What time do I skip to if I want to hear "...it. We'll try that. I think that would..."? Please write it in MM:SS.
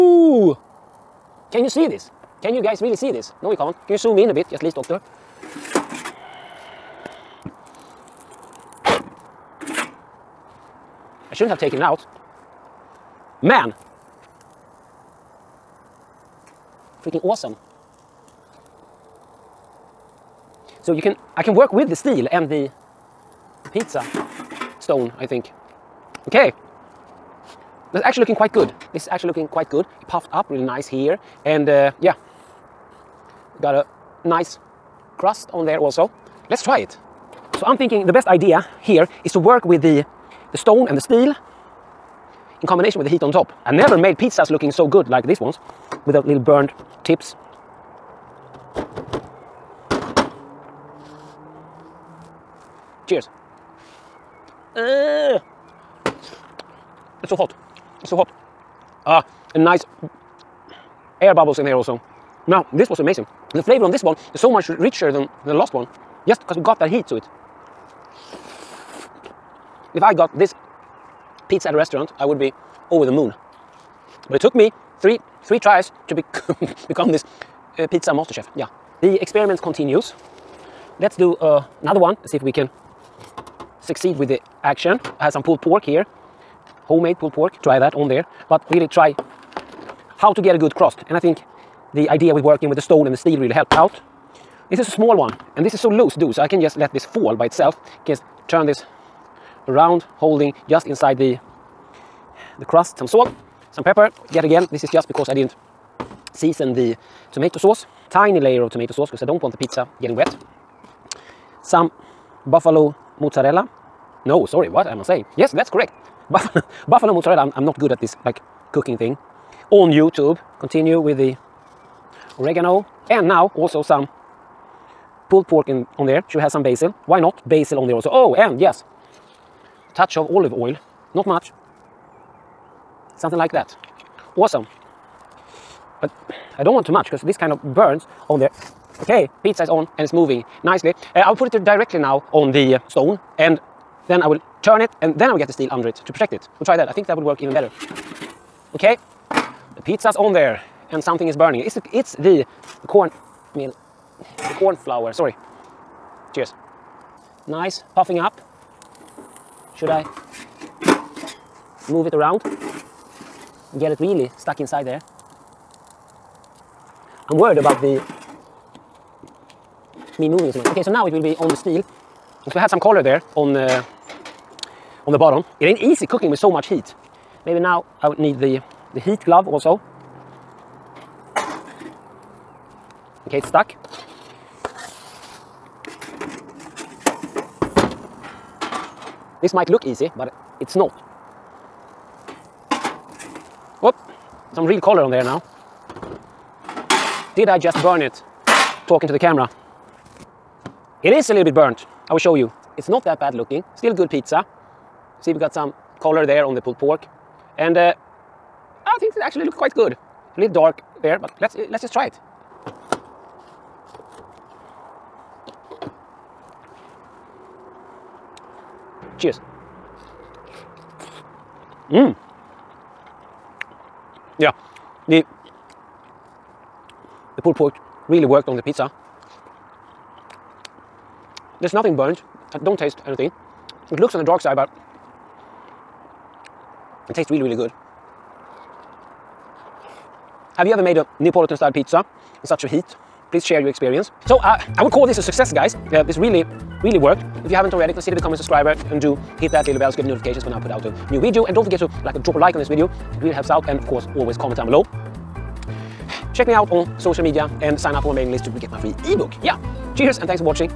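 02:26.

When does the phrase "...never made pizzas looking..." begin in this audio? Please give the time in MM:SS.
00:43.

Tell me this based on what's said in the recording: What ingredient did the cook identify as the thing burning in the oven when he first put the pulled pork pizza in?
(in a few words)
Corn flour.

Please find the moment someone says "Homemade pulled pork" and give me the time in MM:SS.
01:26.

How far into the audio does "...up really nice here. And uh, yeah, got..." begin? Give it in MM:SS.
00:30.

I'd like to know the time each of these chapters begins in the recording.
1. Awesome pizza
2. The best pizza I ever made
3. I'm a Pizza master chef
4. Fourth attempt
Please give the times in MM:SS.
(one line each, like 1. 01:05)
1. 00:16
2. 00:42
3. 01:09
4. 01:20.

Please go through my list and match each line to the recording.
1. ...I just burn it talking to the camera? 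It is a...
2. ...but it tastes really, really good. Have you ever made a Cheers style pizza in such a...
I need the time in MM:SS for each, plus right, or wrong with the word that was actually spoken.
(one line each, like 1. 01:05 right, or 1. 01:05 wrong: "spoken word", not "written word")
1. 03:17 right
2. 03:54 wrong: "Neapolitan", not "Cheers".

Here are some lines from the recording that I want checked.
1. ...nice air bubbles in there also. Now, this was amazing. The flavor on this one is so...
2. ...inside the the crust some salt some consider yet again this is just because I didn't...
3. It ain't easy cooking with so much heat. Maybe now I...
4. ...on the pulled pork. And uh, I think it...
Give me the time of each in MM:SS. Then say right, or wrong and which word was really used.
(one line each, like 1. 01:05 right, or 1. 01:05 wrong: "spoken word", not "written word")
1. 00:59 right
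2. 01:40 wrong: "pepper", not "consider"
3. 02:55 right
4. 03:26 right.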